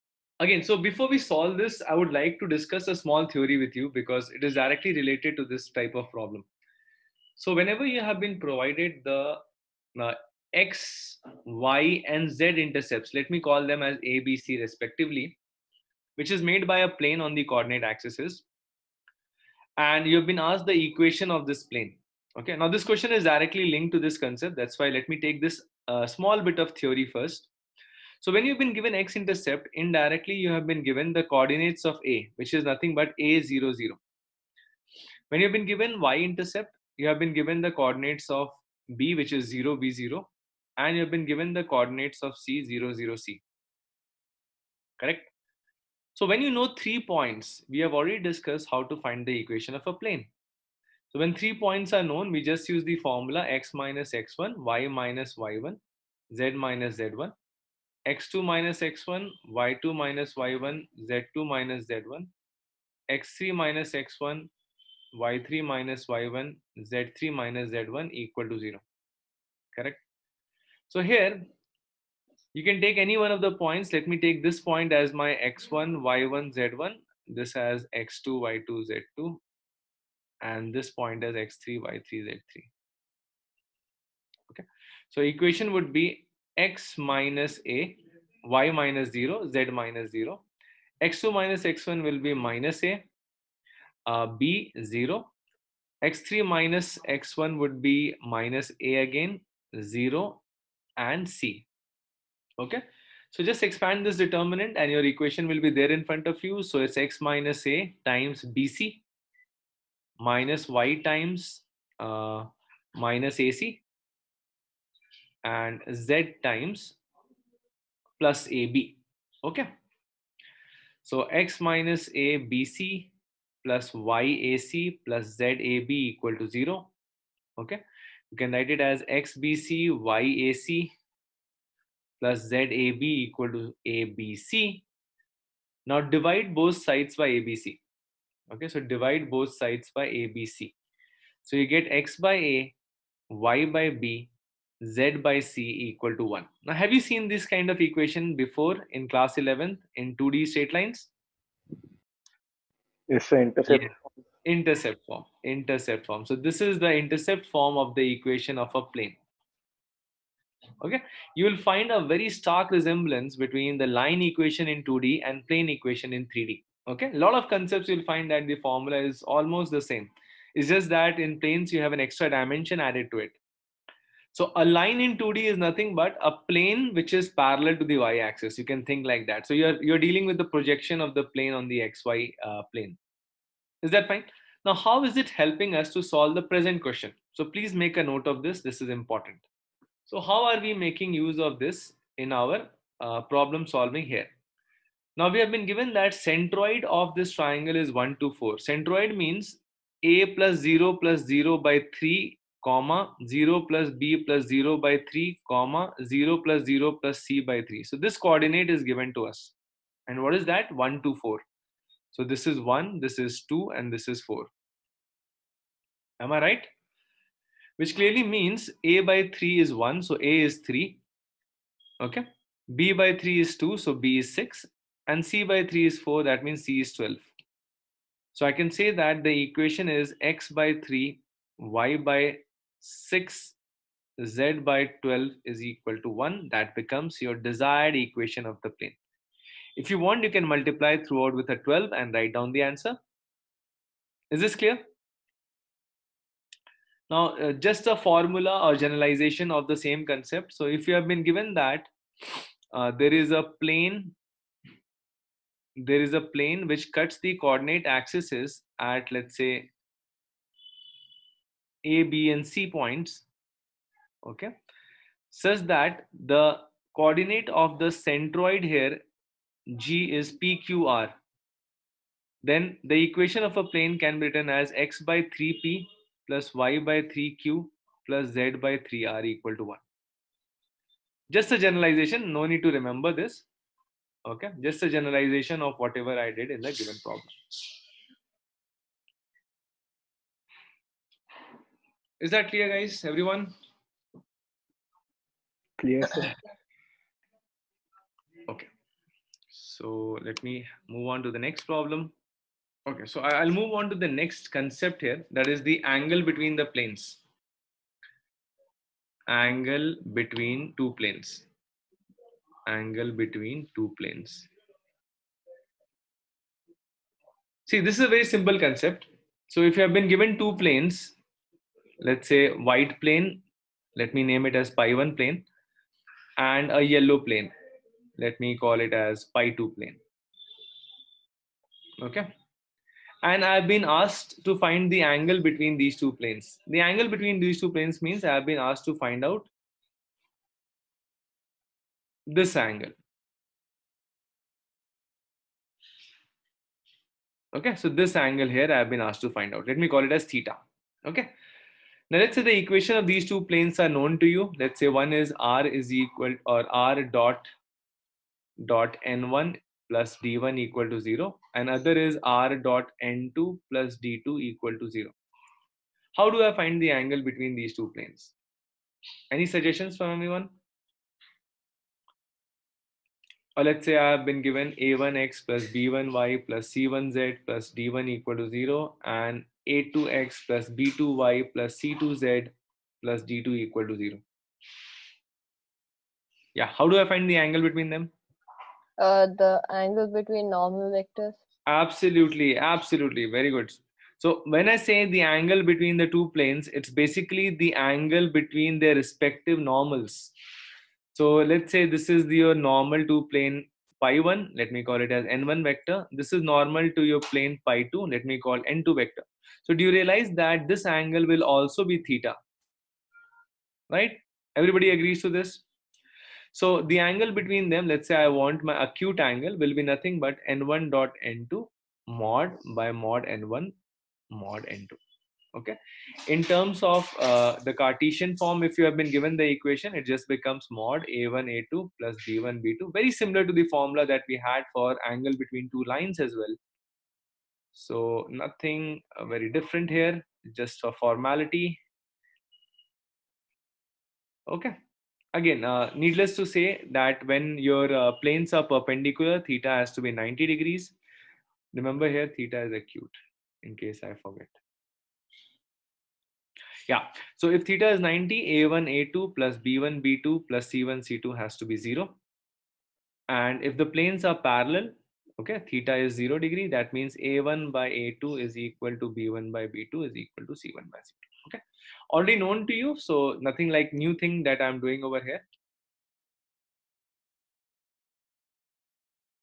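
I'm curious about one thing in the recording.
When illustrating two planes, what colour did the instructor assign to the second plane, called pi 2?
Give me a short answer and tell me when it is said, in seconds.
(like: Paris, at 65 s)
Yellow, at 326 s.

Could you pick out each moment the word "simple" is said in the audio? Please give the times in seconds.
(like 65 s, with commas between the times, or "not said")
318 s.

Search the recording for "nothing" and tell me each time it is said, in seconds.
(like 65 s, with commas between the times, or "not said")
32 s, 175 s, 419 s, 438 s, 473 s.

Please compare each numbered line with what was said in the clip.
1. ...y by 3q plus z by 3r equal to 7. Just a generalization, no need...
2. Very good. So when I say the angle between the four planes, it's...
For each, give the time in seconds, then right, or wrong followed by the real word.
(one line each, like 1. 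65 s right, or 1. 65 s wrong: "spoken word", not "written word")
1. 276 s wrong: "1", not "7"
2. 393 s wrong: "two", not "four".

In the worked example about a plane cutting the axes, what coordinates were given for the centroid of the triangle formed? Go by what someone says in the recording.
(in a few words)
1, 2, 4.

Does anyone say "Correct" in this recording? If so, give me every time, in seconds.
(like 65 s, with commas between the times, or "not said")
44 s, 69 s.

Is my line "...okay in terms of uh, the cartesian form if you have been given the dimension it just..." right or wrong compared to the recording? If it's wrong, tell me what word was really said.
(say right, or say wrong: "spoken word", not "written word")
wrong: "equation", not "dimension".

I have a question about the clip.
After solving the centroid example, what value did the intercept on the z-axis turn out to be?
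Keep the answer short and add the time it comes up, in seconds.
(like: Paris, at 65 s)
12, at 226 s.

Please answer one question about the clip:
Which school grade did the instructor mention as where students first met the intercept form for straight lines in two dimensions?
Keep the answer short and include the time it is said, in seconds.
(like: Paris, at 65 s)
11th, at 149 s.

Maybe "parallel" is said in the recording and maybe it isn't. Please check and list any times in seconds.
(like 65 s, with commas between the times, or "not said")
177 s, 464 s.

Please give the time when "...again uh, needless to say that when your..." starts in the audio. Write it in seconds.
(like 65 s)
445 s.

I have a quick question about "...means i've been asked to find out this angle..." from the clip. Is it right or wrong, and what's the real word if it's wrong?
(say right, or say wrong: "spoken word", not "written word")
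right.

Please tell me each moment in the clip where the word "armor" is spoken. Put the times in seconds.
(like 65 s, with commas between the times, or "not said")
not said.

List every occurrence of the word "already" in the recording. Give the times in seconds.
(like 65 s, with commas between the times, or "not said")
47 s, 472 s.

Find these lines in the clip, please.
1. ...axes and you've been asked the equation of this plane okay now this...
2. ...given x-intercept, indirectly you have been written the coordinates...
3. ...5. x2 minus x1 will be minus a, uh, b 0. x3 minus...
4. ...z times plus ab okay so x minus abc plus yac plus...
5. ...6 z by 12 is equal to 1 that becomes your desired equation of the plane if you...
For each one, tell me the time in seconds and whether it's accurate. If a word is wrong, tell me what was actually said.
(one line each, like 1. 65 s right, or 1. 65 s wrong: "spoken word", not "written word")
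1. 17 s right
2. 28 s wrong: "given", not "written"
3. 90 s wrong: "0", not "5"
4. 116 s right
5. 232 s right.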